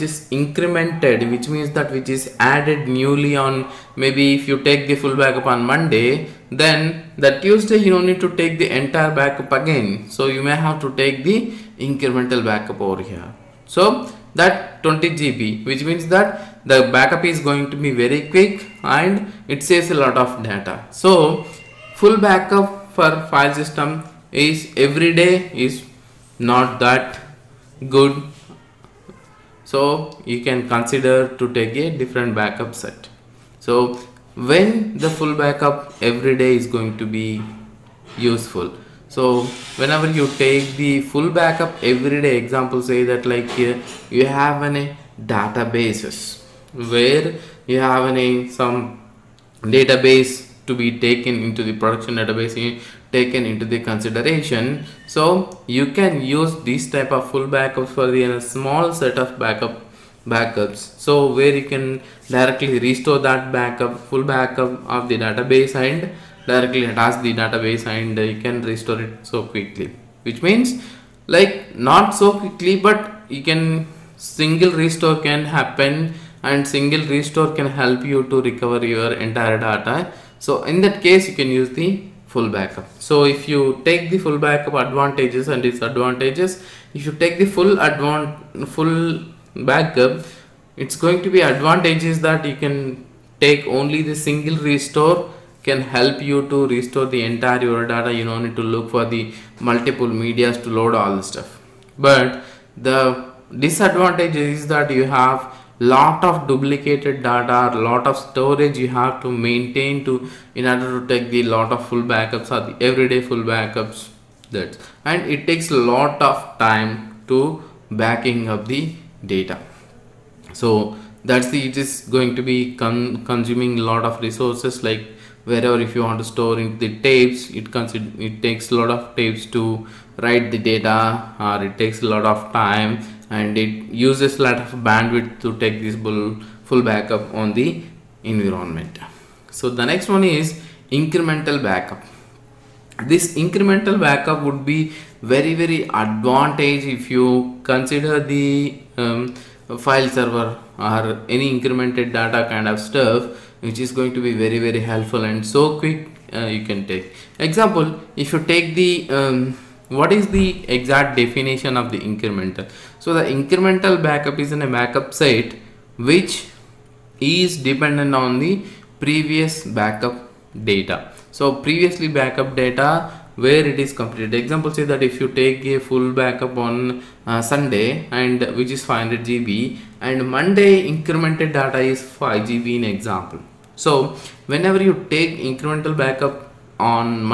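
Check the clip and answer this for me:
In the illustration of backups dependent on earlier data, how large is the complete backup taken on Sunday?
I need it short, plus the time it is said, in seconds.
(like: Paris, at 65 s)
500 GB, at 178 s.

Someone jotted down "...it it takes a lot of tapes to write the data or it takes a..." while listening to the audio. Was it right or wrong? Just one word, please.
right.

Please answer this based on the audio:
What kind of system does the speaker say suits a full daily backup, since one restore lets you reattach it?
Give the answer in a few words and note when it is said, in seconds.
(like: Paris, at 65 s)
Production database, at 51 s.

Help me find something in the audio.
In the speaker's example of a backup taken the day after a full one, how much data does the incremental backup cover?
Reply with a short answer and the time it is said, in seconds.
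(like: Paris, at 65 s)
20 GB, at 14 s.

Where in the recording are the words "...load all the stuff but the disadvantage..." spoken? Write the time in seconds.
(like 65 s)
100 s.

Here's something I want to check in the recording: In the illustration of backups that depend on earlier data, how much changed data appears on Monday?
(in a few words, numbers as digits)
5 GB.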